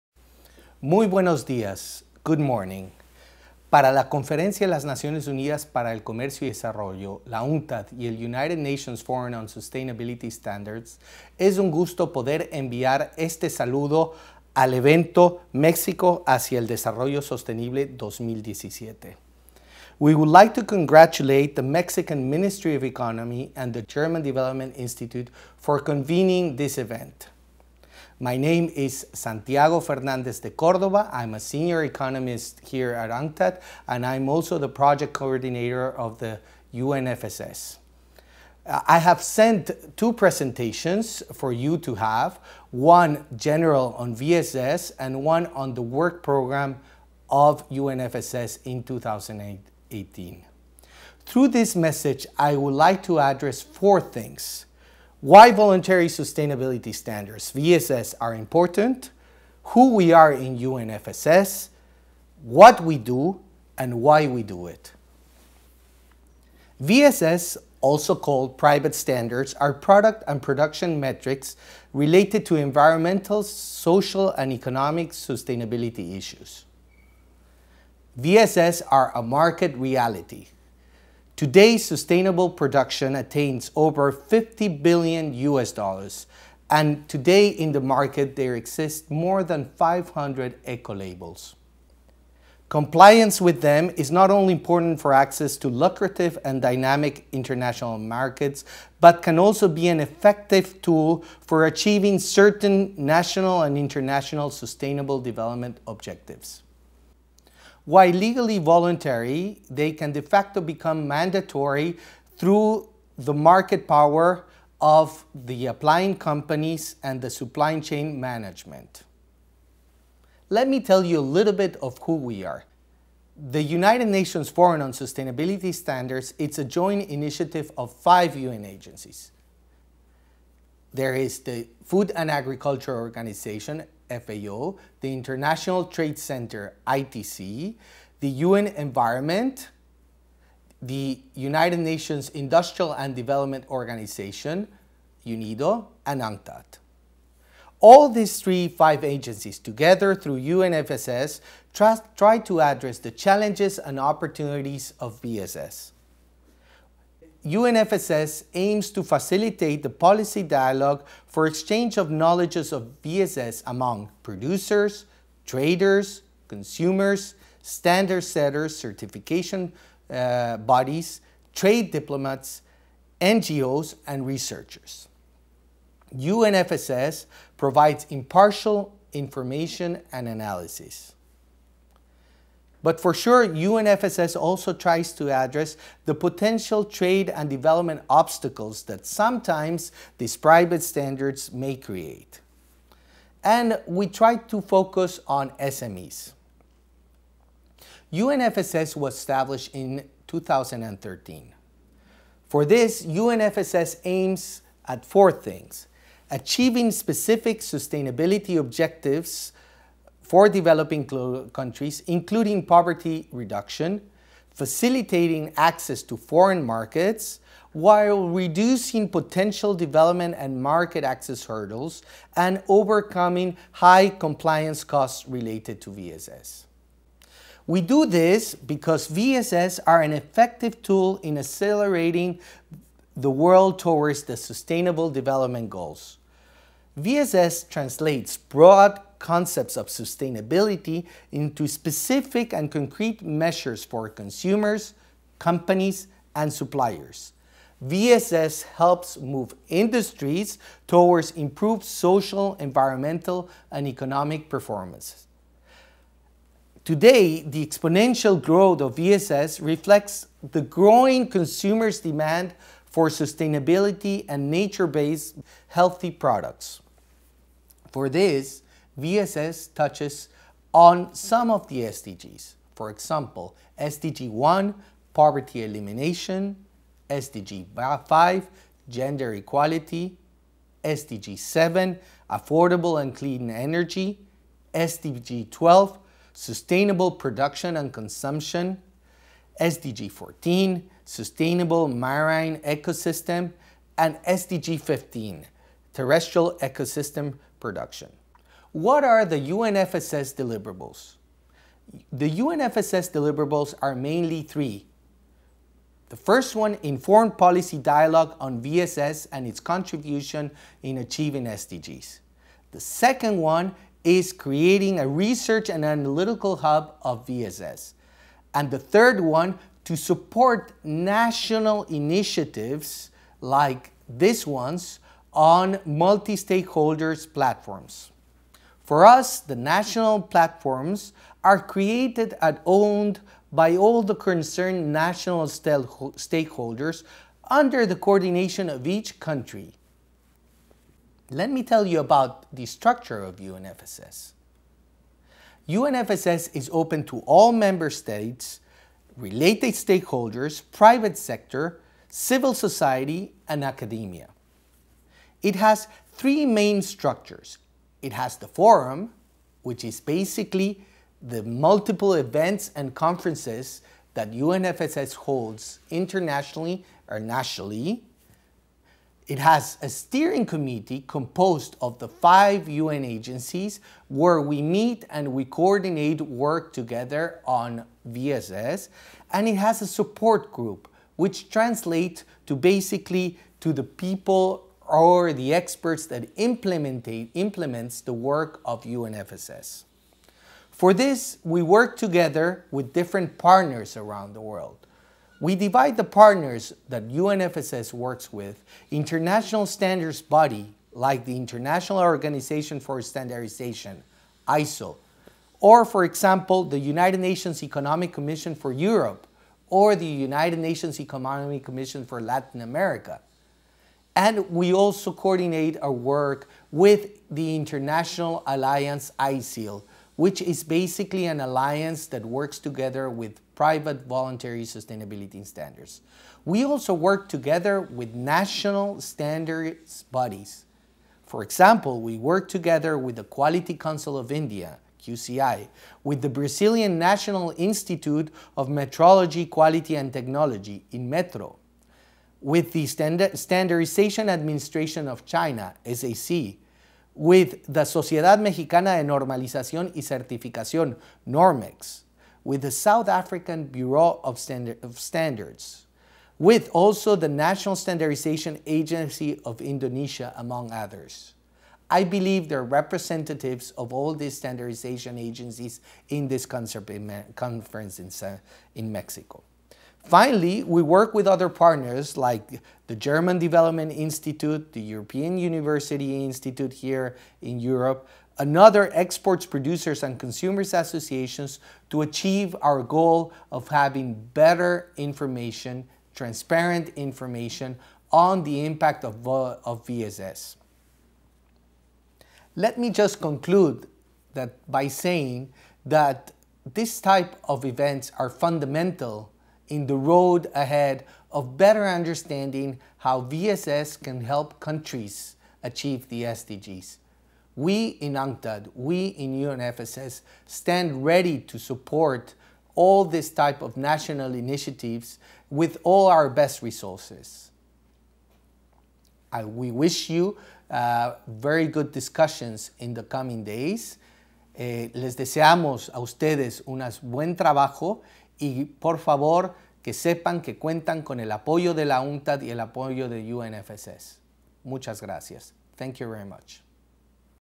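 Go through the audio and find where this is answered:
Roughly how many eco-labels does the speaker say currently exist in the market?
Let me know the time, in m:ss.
1:29.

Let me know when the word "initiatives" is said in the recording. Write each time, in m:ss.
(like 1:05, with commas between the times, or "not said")
2:07, 5:21, 8:34.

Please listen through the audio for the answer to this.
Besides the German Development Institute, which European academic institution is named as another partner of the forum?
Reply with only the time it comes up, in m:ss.
7:54.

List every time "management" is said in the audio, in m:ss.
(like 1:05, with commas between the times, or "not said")
1:58.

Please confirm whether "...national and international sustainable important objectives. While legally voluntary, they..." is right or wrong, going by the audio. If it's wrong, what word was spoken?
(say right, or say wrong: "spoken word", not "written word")
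wrong: "development", not "important".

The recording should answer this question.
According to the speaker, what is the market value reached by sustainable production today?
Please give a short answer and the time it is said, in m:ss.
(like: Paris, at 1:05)
over $50 billion, at 1:23.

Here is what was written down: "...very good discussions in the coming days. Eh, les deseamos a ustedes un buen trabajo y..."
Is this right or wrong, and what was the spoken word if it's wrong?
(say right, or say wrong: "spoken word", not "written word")
right.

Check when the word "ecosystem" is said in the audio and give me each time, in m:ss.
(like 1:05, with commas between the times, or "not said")
4:52, 4:56.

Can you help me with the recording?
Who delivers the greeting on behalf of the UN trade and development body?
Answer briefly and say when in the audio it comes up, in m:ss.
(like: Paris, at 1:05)
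Santiago Fernandez de Cordoba, at 0:29.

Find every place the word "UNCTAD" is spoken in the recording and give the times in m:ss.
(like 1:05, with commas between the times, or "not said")
0:07, 0:33, 2:26, 8:28.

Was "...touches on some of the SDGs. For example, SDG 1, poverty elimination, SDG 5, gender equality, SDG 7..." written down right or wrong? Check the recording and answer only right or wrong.
right.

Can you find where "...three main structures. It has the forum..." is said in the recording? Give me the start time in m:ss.
5:56.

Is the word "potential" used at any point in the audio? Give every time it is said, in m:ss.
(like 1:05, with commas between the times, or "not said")
3:06, 3:39.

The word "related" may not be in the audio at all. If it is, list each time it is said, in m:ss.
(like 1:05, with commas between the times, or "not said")
1:11, 3:45, 5:49.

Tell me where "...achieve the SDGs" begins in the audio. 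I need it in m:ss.
8:25.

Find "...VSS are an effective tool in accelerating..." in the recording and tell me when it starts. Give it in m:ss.
3:49.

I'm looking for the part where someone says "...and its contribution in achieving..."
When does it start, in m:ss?
5:09.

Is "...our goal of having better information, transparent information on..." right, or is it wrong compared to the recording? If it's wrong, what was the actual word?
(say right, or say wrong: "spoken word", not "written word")
right.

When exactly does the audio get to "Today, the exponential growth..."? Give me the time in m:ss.
4:16.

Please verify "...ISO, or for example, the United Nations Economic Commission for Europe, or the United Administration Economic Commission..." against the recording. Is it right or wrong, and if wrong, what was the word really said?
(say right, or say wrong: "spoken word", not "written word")
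wrong: "Nations", not "Administration".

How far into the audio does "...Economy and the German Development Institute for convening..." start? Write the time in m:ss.
0:22.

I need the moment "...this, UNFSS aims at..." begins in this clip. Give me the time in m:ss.
3:22.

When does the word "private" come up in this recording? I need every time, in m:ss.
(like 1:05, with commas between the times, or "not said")
1:08, 3:10, 5:50, 7:03.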